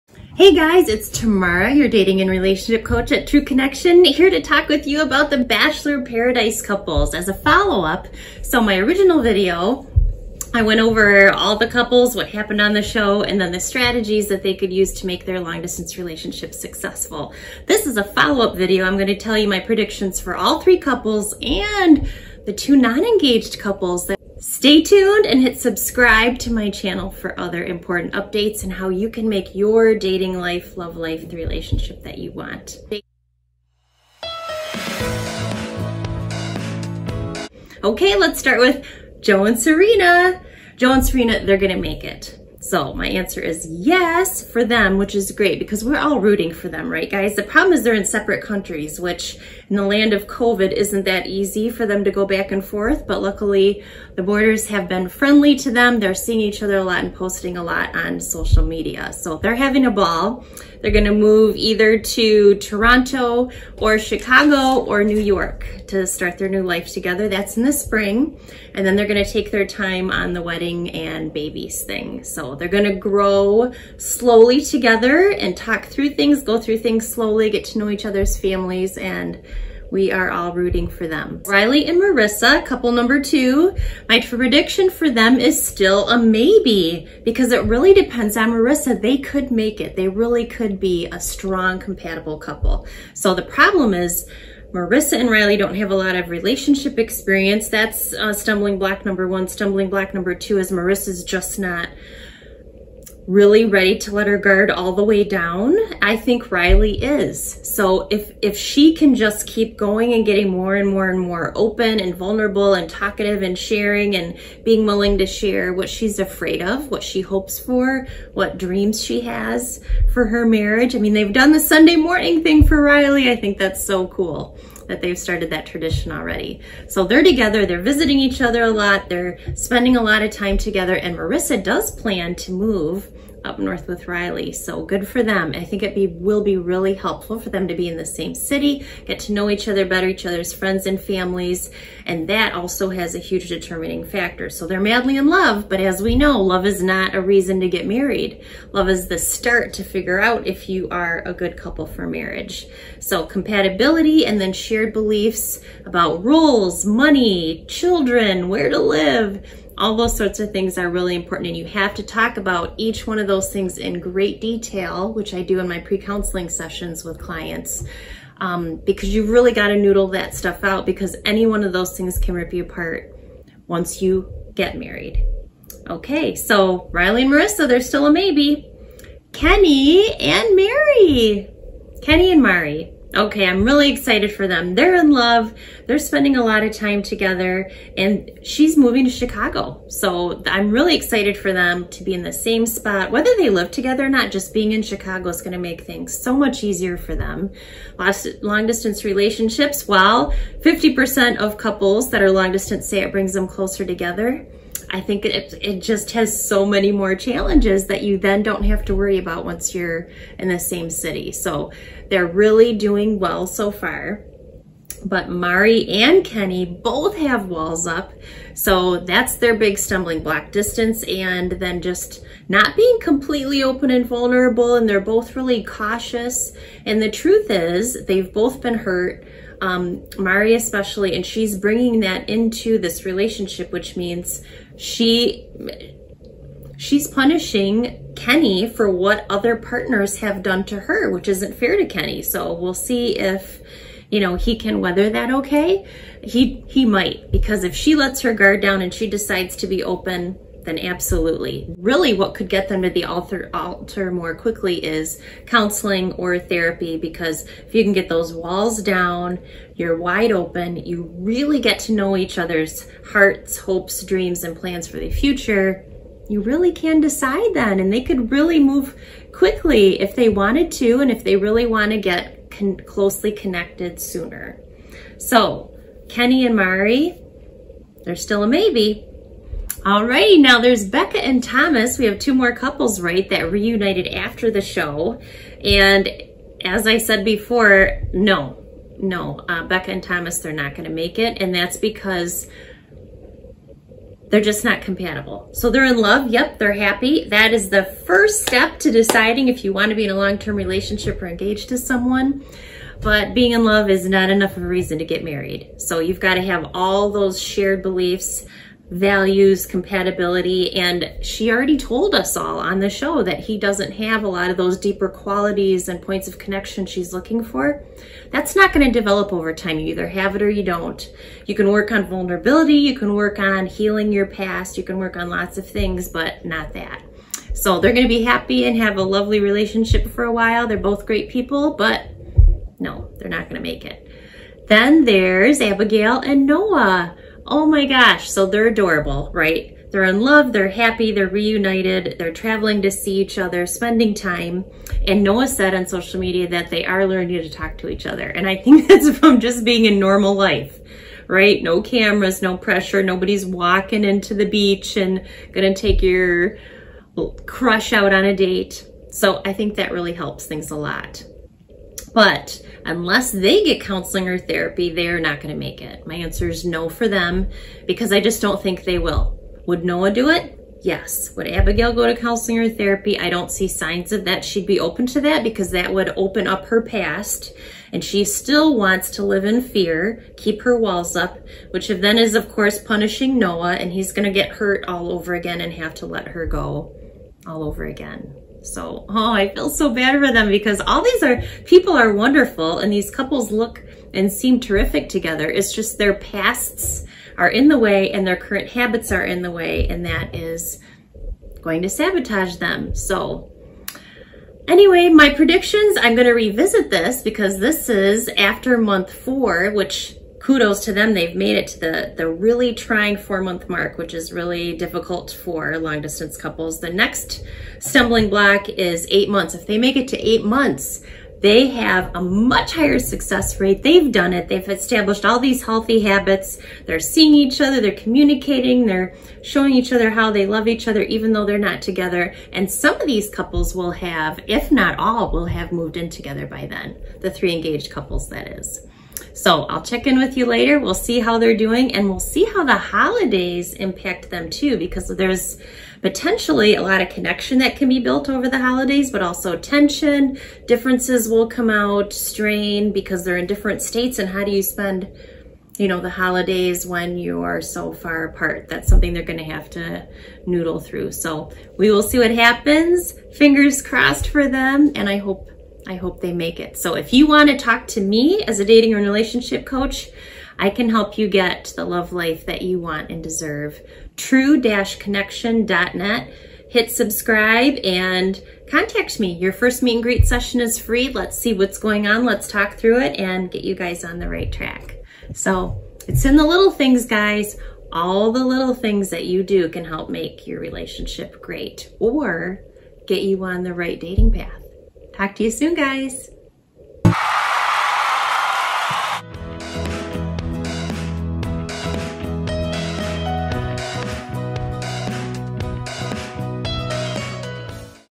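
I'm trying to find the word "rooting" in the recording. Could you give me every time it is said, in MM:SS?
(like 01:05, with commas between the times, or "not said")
00:46, 01:20.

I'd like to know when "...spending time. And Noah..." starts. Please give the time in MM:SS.
05:43.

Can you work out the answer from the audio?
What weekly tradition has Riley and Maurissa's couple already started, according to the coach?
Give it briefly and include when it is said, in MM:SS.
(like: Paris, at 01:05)
Sunday morning thing, at 02:01.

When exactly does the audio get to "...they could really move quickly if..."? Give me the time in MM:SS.
04:27.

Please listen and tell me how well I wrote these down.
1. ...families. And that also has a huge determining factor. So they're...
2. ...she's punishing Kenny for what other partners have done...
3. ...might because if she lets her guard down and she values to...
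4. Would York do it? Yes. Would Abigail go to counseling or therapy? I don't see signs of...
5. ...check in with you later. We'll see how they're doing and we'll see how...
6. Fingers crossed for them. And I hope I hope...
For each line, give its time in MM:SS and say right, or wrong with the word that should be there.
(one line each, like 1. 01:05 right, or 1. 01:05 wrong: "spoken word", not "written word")
1. 02:20 right
2. 03:56 right
3. 04:06 wrong: "decides", not "values"
4. 06:09 wrong: "Noah", not "York"
5. 07:19 right
6. 07:43 right.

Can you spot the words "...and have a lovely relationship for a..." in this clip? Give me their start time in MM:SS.
05:28.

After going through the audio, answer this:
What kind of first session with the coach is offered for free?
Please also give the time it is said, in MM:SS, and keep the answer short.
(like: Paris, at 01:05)
meet and greet, at 07:59.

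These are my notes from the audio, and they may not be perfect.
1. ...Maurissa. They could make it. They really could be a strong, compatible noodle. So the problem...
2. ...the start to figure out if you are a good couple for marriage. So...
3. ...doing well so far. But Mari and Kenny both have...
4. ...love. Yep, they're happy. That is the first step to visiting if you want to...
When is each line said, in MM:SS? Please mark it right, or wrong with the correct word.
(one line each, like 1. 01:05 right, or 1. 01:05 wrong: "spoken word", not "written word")
1. 01:28 wrong: "couple", not "noodle"
2. 02:29 right
3. 03:32 right
4. 04:55 wrong: "deciding", not "visiting".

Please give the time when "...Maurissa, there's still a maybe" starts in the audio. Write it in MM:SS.
02:57.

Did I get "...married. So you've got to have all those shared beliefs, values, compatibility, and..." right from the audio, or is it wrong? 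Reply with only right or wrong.
right.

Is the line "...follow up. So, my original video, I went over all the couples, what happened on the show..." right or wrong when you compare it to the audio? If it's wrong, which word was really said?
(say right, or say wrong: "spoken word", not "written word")
right.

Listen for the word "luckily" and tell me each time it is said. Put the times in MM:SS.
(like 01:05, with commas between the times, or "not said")
00:53.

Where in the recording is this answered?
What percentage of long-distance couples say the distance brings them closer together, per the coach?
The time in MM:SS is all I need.
03:20.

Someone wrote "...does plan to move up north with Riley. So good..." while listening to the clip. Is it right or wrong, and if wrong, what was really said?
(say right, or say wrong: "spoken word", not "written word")
right.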